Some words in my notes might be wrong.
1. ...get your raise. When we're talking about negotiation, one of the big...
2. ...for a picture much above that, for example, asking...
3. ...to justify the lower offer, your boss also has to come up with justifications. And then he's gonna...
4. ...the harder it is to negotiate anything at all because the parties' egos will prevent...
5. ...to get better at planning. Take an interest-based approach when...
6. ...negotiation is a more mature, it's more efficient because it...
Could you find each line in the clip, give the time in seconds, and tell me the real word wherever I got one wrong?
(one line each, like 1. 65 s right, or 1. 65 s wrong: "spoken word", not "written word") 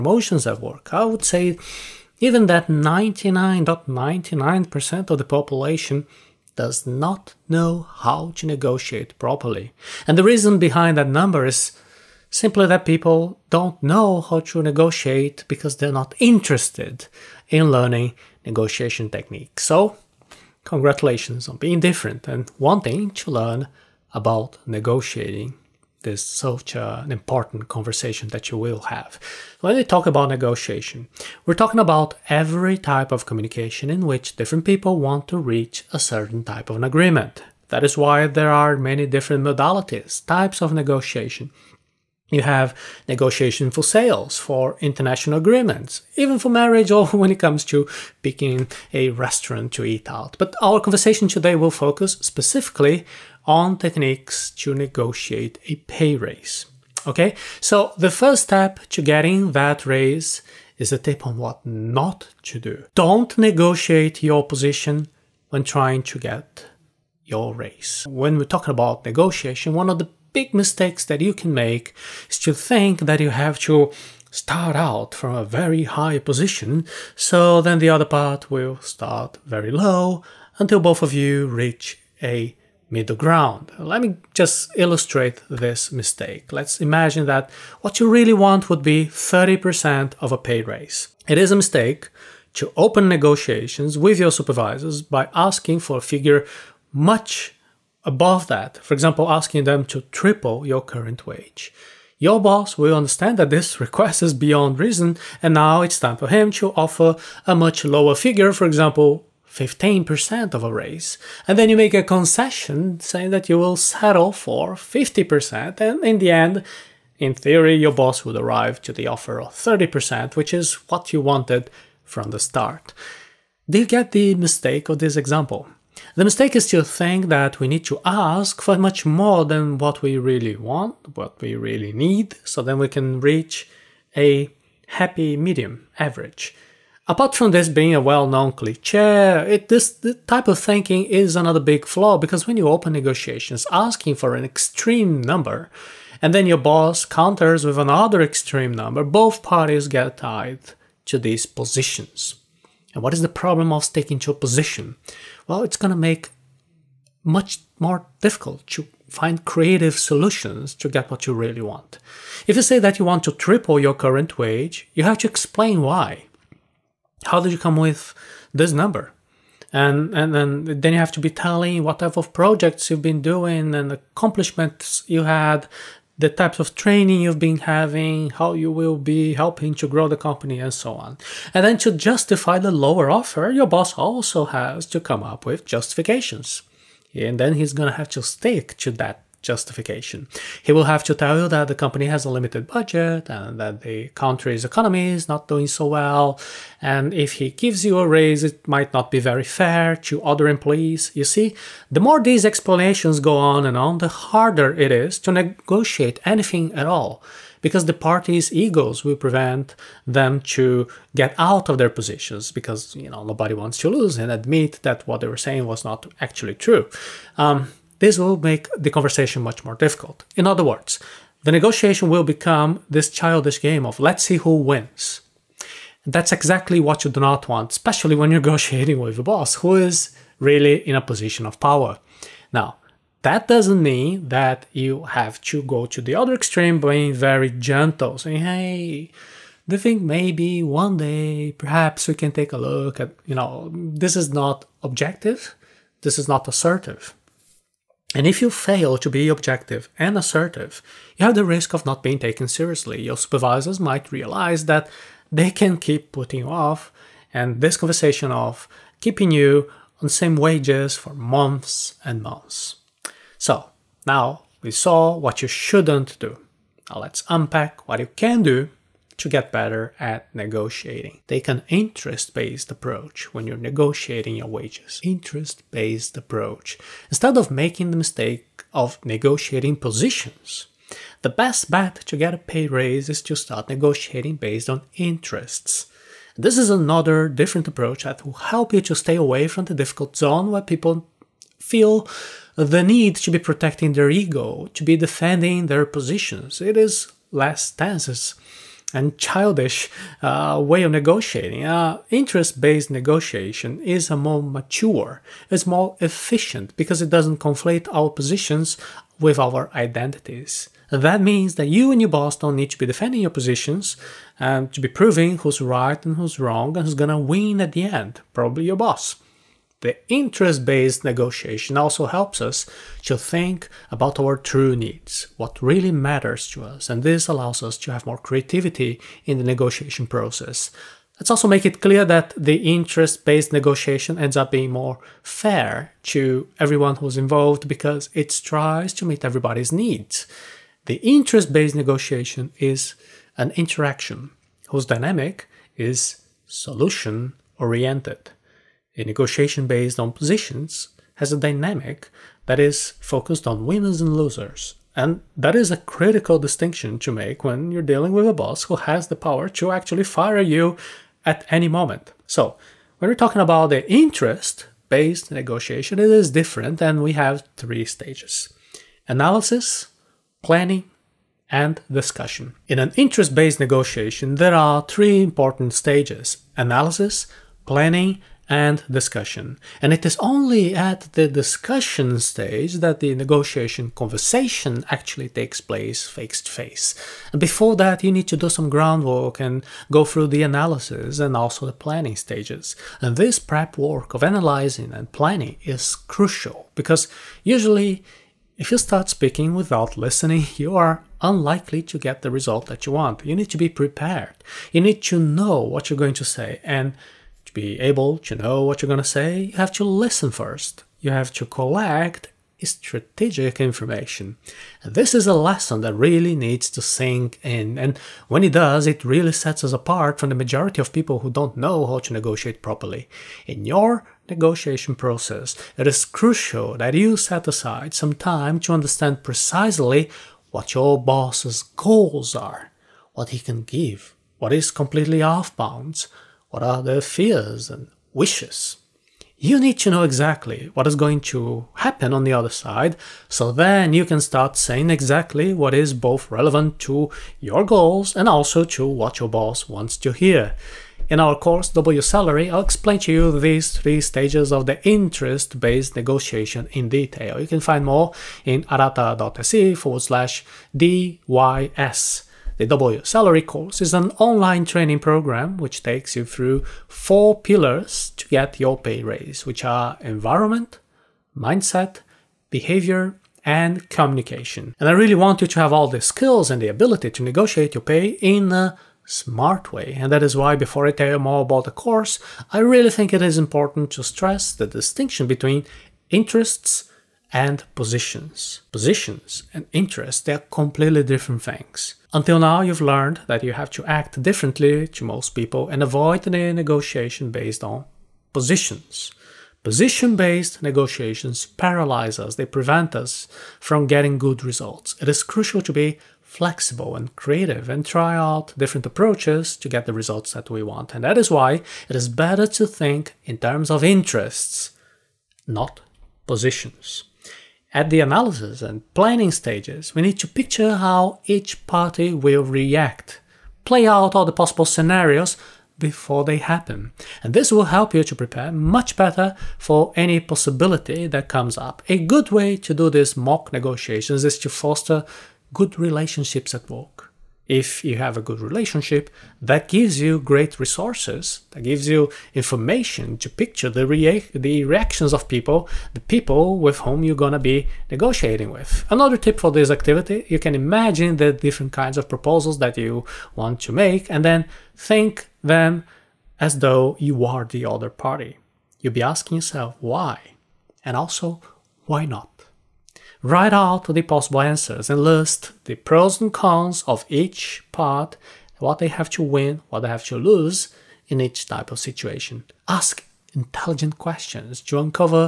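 1. 66 s right
2. 95 s wrong: "figure", not "picture"
3. 181 s right
4. 203 s right
5. 269 s wrong: "negotiating", not "planning"
6. 302 s right.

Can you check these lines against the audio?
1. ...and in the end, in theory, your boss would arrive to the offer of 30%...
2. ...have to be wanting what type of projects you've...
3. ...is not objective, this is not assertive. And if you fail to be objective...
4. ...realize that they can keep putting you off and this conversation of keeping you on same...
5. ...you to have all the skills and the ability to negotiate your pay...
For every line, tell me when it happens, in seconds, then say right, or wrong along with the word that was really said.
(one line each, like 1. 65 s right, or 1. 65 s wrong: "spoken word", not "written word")
1. 115 s right
2. 170 s wrong: "telling", not "wanting"
3. 244 s right
4. 254 s right
5. 475 s right.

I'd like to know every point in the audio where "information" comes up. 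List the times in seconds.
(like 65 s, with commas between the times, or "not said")
413 s, 542 s.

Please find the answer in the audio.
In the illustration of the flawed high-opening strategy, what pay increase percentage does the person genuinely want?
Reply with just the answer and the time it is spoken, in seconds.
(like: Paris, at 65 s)
30%, at 89 s.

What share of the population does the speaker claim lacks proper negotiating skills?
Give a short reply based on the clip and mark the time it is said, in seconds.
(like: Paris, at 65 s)
99.99%, at 2 s.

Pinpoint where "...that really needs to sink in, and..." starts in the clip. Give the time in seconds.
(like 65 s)
415 s.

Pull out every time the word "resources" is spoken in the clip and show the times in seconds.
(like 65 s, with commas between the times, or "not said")
540 s.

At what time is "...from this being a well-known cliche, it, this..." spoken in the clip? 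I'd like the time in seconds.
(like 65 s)
137 s.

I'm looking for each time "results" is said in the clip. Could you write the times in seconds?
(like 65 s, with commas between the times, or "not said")
402 s, 504 s, 509 s.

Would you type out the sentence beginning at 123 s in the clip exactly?
Do you get the mistake of this example?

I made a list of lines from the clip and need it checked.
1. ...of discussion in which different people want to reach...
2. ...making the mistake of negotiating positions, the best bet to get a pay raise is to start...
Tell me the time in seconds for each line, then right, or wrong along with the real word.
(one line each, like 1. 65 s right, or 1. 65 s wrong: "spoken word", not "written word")
1. 33 s wrong: "communication", not "discussion"
2. 277 s right.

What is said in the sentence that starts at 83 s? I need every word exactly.
Let me just illustrate this mistake.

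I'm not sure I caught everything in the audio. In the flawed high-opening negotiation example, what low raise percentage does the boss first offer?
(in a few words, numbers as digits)
15%.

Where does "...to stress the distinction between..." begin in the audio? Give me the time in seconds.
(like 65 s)
483 s.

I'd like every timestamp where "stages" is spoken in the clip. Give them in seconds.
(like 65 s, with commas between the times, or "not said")
367 s, 375 s, 382 s, 392 s, 454 s, 519 s.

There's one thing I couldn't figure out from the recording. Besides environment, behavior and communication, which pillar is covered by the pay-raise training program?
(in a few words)
mindset.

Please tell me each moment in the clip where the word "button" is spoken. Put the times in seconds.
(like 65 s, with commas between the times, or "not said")
not said.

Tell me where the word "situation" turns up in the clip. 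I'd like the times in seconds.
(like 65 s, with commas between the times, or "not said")
571 s.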